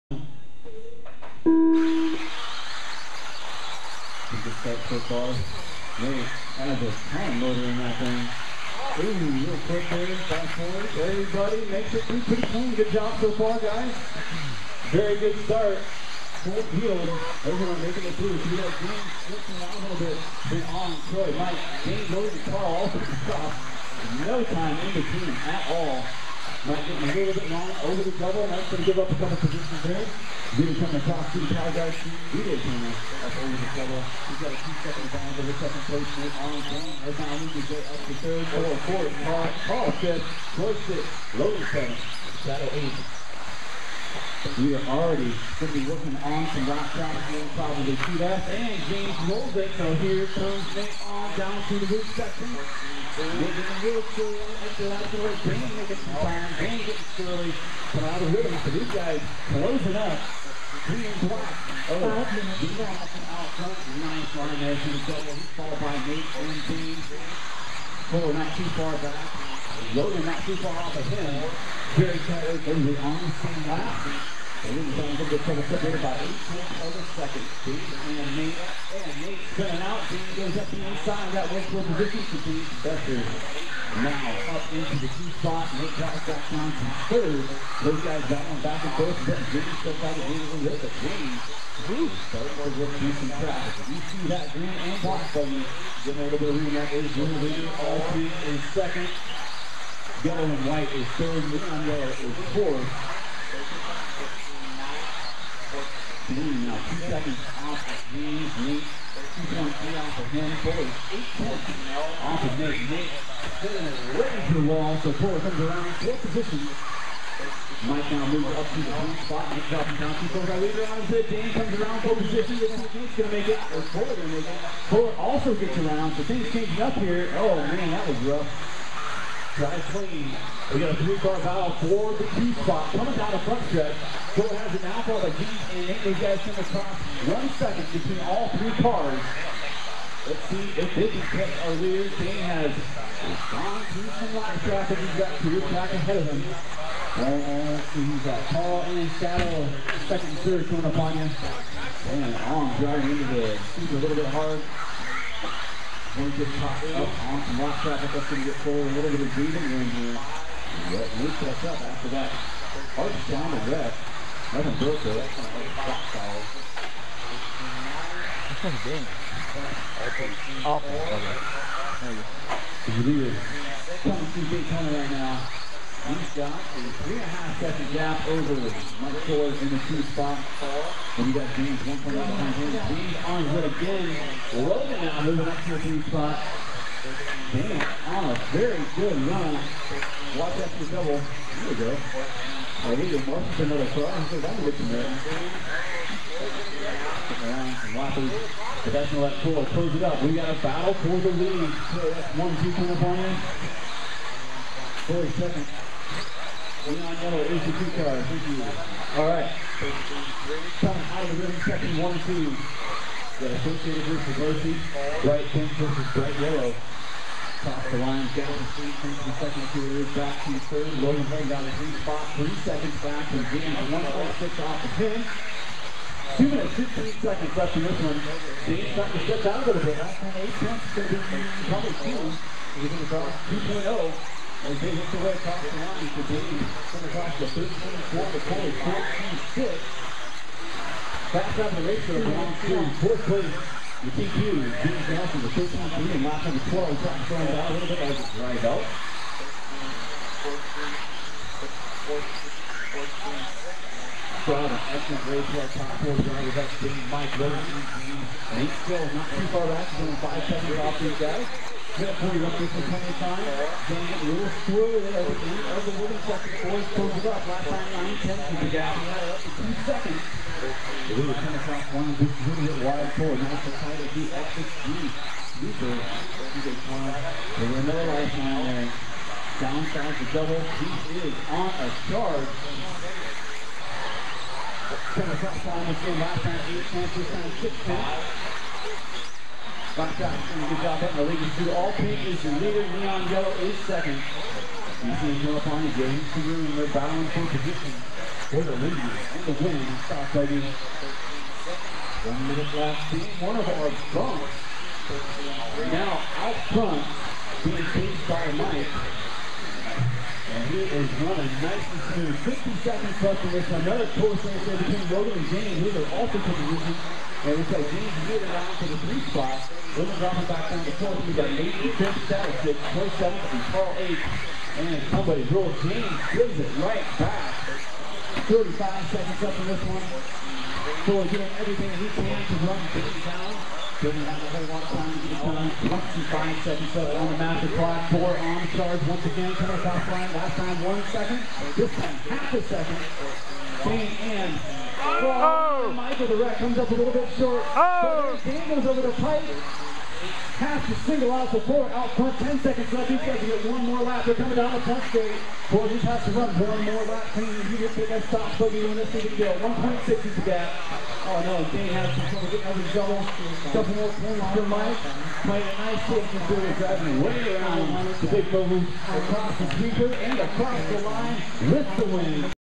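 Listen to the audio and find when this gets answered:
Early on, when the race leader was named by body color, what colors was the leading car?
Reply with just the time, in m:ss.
1:34.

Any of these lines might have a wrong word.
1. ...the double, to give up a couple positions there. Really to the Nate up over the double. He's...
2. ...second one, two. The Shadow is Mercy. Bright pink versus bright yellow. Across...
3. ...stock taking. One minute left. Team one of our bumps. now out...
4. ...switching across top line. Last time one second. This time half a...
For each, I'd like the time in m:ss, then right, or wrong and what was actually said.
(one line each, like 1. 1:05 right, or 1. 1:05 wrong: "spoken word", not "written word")
1. 0:28 wrong: "Really", not "Nate"
2. 3:31 wrong: "Associated", not "Shadow"
3. 5:00 right
4. 5:39 wrong: "coming", not "switching".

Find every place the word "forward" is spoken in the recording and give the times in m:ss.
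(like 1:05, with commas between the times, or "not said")
0:10, 2:38.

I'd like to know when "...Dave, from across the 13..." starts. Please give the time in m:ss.
3:56.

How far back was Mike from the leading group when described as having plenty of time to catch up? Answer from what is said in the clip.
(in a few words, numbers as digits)
5 seconds.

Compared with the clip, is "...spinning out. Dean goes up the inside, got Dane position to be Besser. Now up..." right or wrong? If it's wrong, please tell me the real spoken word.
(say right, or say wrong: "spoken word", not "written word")
wrong: "Westwood", not "Dane".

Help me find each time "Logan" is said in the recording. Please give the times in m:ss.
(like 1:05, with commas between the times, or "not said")
3:04, 3:40, 5:15, 5:19.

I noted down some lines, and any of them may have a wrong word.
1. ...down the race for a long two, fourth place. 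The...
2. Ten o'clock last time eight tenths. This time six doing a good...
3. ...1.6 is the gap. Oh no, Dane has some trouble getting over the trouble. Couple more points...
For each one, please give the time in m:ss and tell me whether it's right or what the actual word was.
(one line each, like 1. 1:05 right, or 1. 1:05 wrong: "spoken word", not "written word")
1. 4:01 right
2. 4:45 right
3. 5:59 wrong: "double", not "trouble".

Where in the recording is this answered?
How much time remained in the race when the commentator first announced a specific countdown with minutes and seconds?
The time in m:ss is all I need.
3:46.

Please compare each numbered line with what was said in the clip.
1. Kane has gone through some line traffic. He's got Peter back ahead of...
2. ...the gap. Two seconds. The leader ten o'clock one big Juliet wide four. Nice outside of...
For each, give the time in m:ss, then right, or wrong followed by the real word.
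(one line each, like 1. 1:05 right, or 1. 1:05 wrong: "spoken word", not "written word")
1. 2:22 right
2. 4:28 right.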